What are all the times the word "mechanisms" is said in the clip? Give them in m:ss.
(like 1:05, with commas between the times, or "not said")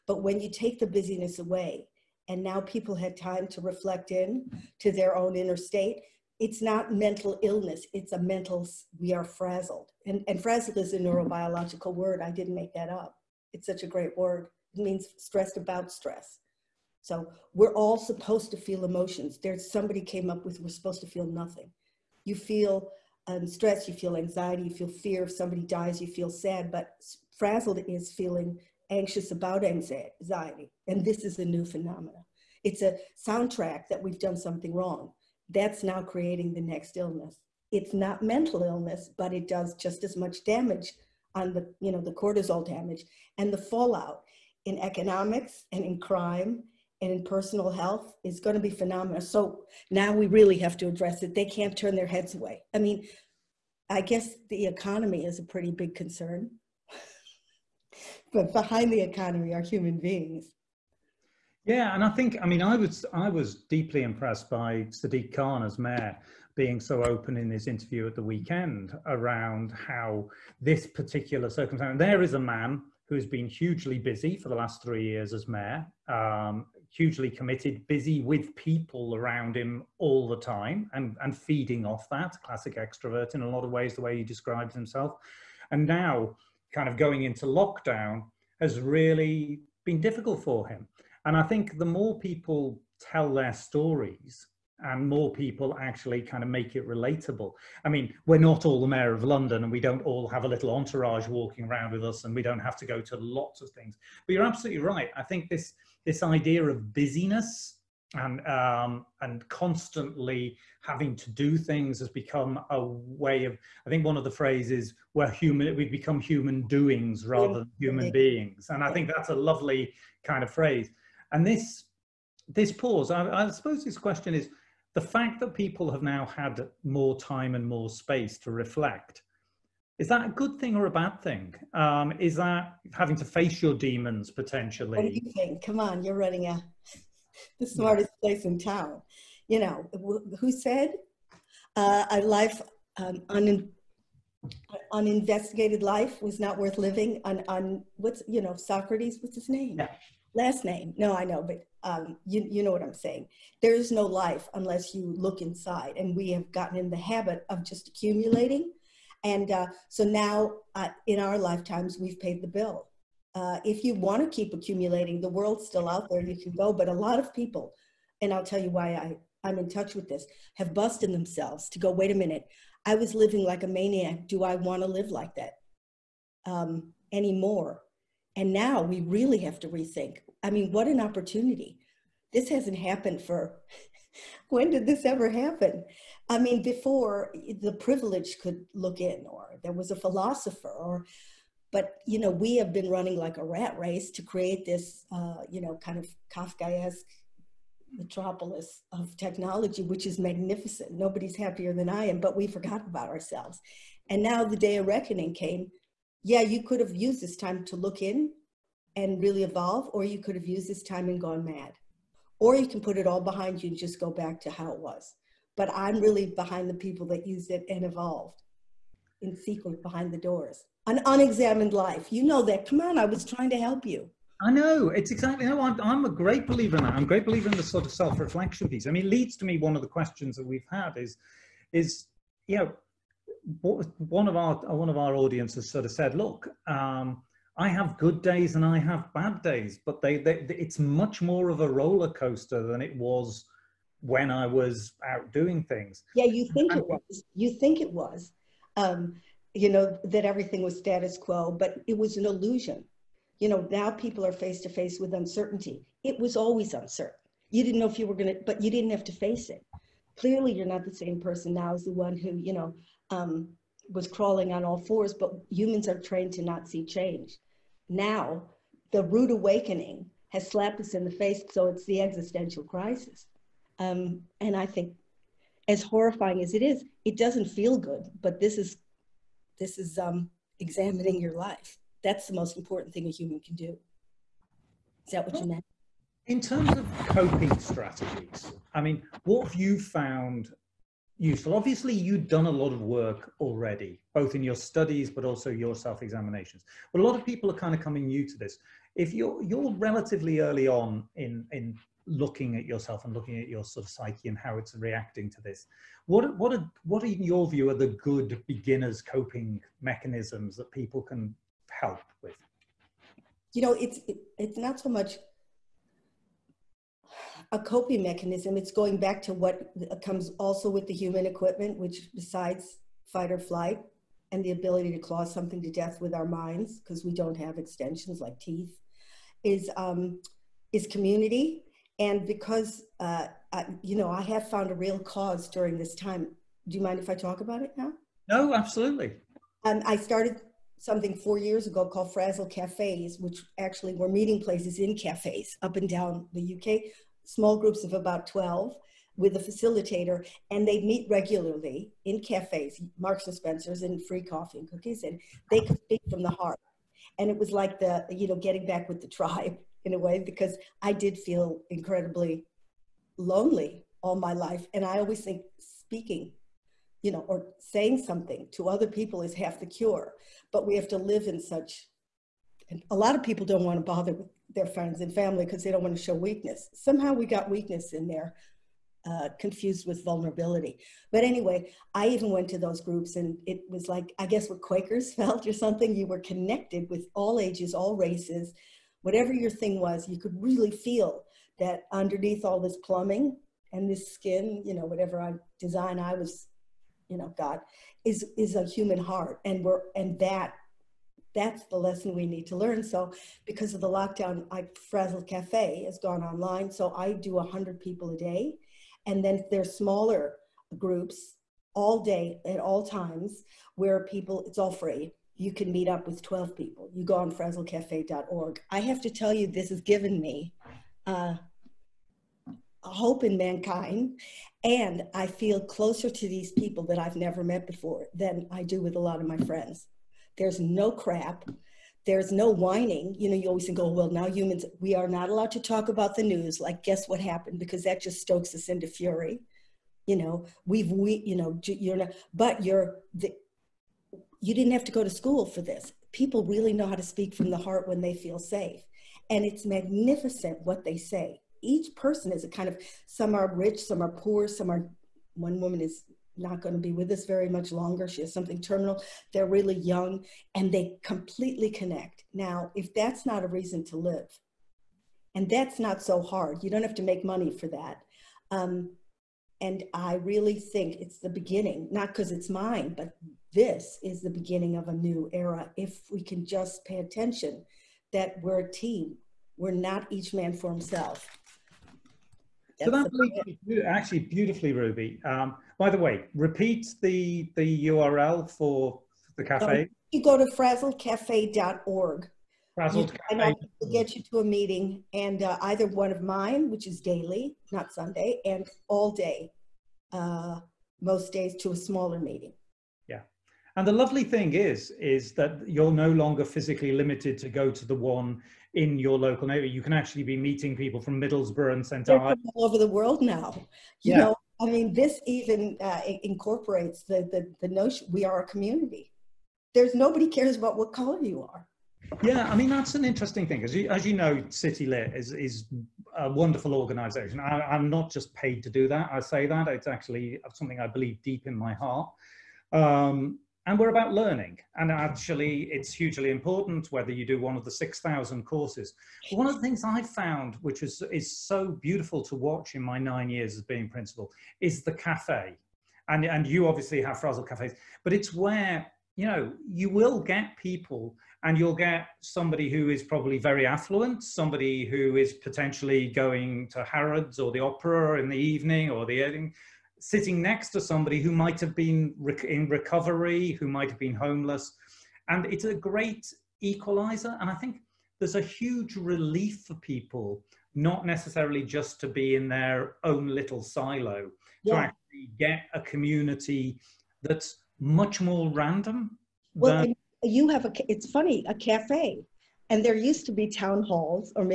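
5:09, 5:18.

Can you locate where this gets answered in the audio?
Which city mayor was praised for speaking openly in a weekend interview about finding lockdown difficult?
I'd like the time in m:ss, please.
1:04.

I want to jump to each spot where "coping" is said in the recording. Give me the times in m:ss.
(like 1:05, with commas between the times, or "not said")
4:47, 5:09, 5:17.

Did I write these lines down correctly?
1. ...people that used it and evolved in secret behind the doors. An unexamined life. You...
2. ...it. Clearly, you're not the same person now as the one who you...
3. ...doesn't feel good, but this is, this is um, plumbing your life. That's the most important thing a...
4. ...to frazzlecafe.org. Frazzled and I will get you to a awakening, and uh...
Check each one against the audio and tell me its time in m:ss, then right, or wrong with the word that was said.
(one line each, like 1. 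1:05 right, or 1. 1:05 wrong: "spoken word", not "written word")
1. 3:36 right
2. 4:19 right
3. 4:37 wrong: "examining", not "plumbing"
4. 8:10 wrong: "meeting", not "awakening".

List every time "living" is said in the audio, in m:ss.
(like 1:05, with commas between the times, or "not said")
2:26, 2:53.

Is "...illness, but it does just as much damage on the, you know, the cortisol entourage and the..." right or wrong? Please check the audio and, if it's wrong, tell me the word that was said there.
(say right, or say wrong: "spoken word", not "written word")
wrong: "damage", not "entourage".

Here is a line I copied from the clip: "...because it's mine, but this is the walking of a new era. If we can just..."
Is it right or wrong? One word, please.
wrong.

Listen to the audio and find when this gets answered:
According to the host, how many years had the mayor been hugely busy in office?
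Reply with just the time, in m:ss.
1:14.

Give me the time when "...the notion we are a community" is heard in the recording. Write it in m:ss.
8:37.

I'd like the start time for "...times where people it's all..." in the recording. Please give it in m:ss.
6:52.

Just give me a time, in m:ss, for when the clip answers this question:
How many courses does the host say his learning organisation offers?
8:57.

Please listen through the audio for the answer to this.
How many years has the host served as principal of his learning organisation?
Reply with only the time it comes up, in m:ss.
9:02.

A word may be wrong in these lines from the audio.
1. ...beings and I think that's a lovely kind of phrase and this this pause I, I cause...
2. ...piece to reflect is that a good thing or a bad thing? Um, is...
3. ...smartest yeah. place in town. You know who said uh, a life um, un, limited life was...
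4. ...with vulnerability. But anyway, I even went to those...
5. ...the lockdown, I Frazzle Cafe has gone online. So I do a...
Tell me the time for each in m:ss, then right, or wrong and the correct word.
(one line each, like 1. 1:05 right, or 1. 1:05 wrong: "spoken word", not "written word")
1. 1:58 wrong: "suppose", not "cause"
2. 2:07 wrong: "space", not "piece"
3. 2:17 wrong: "uninvestigated", not "limited"
4. 6:19 right
5. 6:43 right.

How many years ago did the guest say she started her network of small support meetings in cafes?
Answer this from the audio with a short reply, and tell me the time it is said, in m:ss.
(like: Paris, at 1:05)
4, at 5:41.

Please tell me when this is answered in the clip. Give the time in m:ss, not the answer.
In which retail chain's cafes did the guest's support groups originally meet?
5:52.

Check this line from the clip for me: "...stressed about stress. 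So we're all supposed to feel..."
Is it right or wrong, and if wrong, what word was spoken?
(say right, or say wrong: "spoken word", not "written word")
right.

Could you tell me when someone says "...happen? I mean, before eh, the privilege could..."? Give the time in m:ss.
3:05.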